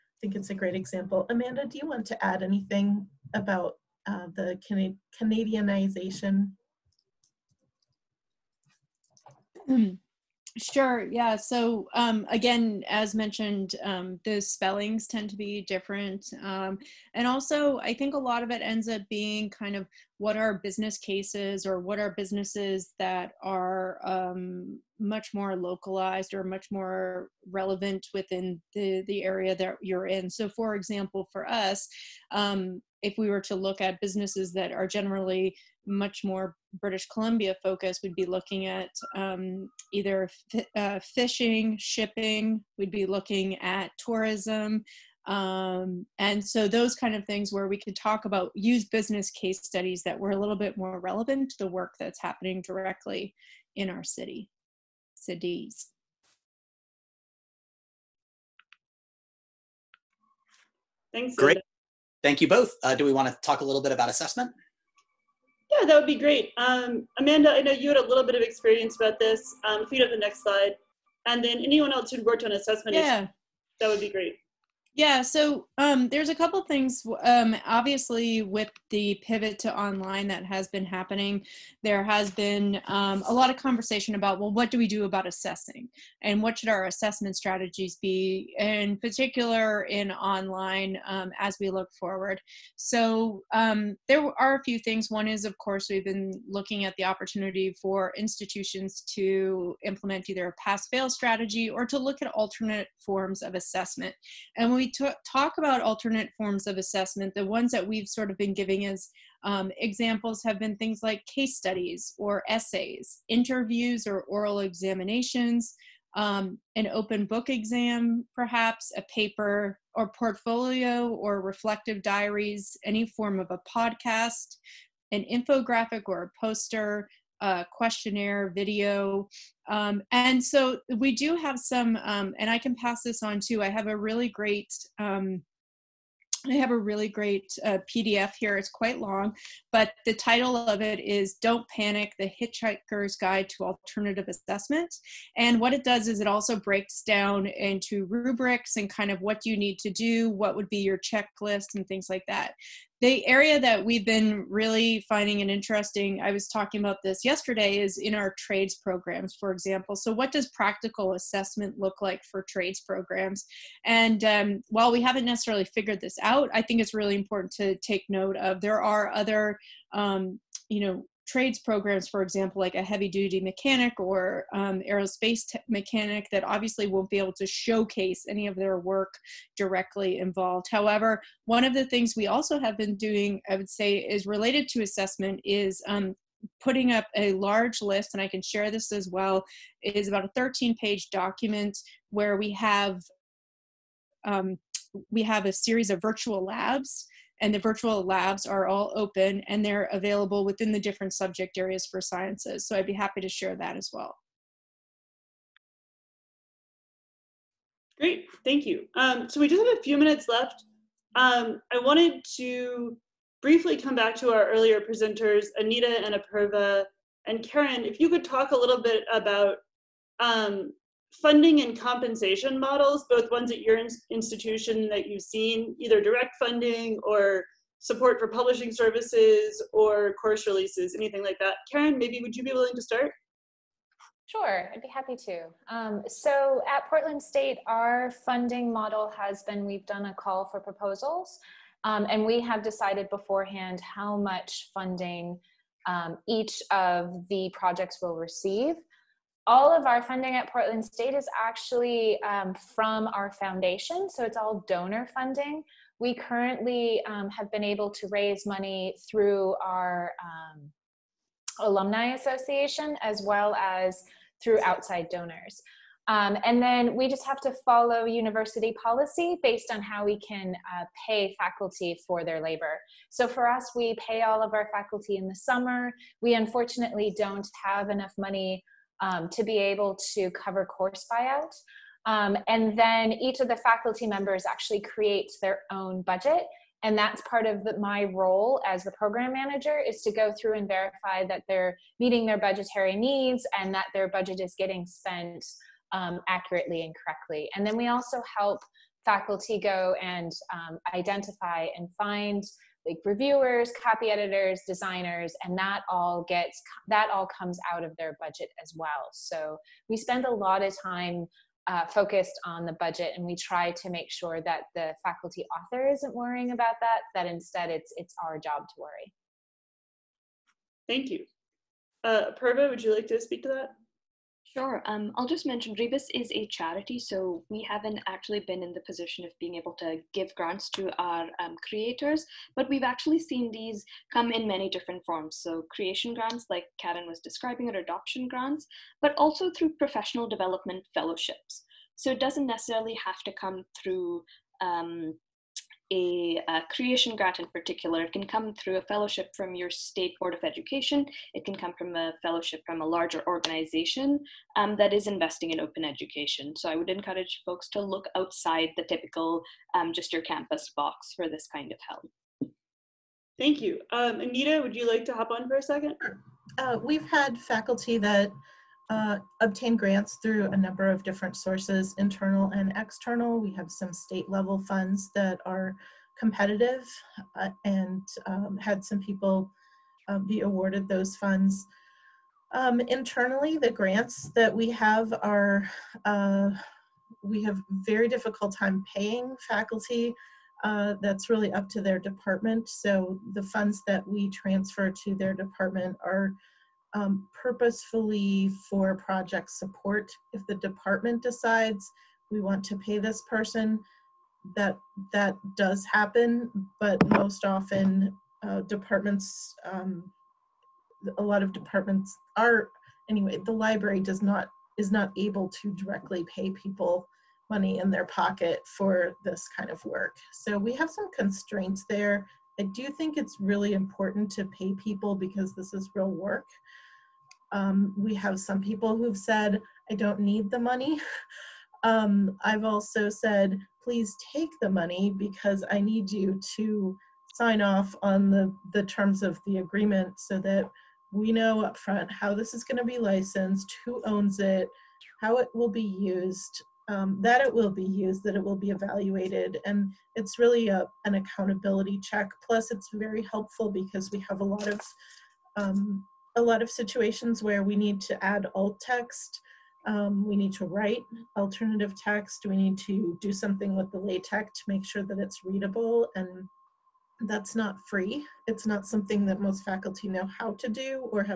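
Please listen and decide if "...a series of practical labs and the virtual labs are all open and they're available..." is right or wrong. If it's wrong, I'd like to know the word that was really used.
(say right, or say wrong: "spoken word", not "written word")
wrong: "virtual", not "practical".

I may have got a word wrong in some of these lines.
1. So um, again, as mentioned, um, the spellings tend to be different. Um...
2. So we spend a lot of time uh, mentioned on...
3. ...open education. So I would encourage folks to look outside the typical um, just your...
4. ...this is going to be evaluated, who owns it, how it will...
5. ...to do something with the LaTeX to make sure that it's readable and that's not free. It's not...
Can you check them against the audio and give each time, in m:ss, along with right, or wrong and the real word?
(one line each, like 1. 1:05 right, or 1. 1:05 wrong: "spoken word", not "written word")
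1. 0:11 right
2. 5:09 wrong: "focused", not "mentioned"
3. 5:55 right
4. 7:22 wrong: "licensed", not "evaluated"
5. 7:42 right.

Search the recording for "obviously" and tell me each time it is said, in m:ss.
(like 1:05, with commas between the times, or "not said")
1:17, 2:56.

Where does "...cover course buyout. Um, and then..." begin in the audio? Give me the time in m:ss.
4:40.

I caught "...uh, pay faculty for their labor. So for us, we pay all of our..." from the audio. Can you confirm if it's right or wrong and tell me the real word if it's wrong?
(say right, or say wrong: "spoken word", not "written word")
right.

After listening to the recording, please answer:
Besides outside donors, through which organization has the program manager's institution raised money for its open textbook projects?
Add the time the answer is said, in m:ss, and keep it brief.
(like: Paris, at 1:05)
alumni association, at 4:21.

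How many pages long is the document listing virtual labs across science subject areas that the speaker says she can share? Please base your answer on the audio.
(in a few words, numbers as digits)
13.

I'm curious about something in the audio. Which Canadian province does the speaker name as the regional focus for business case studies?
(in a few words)
British Columbia.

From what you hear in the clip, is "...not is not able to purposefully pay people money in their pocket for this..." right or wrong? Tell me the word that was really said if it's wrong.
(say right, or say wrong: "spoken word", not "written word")
wrong: "directly", not "purposefully".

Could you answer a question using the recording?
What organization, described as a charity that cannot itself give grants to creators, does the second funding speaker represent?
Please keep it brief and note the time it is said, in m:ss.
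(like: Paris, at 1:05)
Rebus, at 5:25.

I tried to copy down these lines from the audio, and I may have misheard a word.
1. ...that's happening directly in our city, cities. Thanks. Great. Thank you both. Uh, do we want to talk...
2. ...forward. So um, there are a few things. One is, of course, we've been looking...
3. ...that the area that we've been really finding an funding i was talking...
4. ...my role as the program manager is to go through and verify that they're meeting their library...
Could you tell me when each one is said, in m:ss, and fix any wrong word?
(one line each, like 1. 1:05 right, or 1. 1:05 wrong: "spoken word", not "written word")
1. 0:52 right
2. 1:31 right
3. 2:32 wrong: "interesting", not "funding"
4. 4:47 wrong: "budgetary", not "library".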